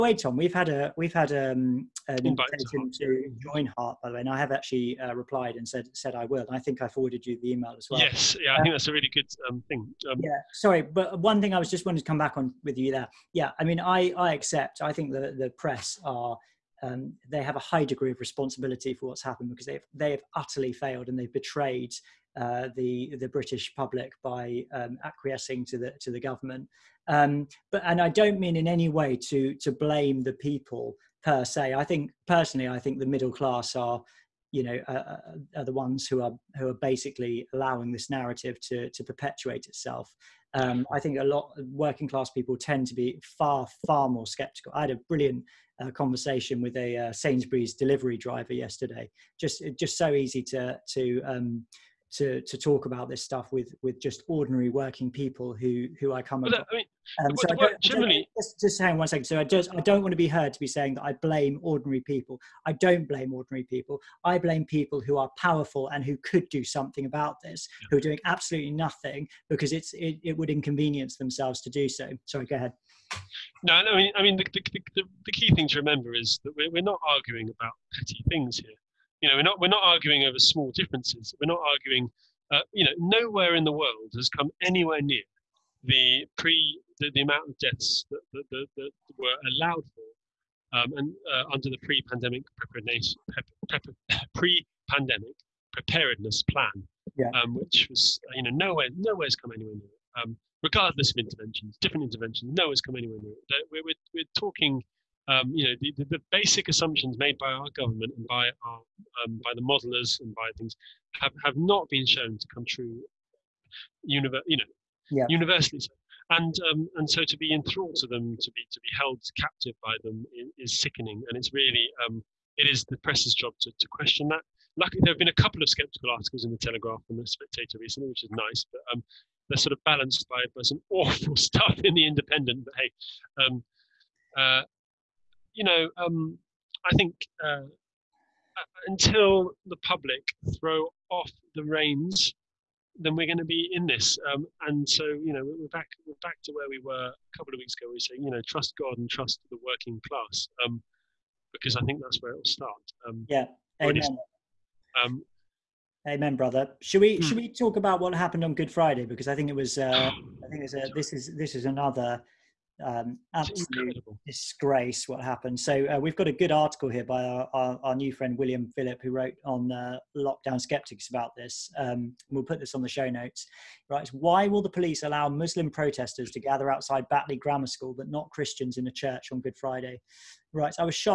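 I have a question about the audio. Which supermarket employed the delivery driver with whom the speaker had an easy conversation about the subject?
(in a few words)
Sainsbury's.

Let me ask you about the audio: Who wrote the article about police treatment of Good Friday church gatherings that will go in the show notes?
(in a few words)
William Philip.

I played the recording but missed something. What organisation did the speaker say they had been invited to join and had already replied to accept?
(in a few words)
HART.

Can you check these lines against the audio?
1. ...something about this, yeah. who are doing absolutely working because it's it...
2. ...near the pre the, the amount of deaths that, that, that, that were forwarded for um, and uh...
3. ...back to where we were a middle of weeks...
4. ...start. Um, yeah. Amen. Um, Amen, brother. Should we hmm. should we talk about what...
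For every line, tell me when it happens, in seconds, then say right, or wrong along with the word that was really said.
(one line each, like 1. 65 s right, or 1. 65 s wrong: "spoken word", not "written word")
1. 66 s wrong: "nothing", not "working"
2. 85 s wrong: "allowed", not "forwarded"
3. 146 s wrong: "couple", not "middle"
4. 152 s right.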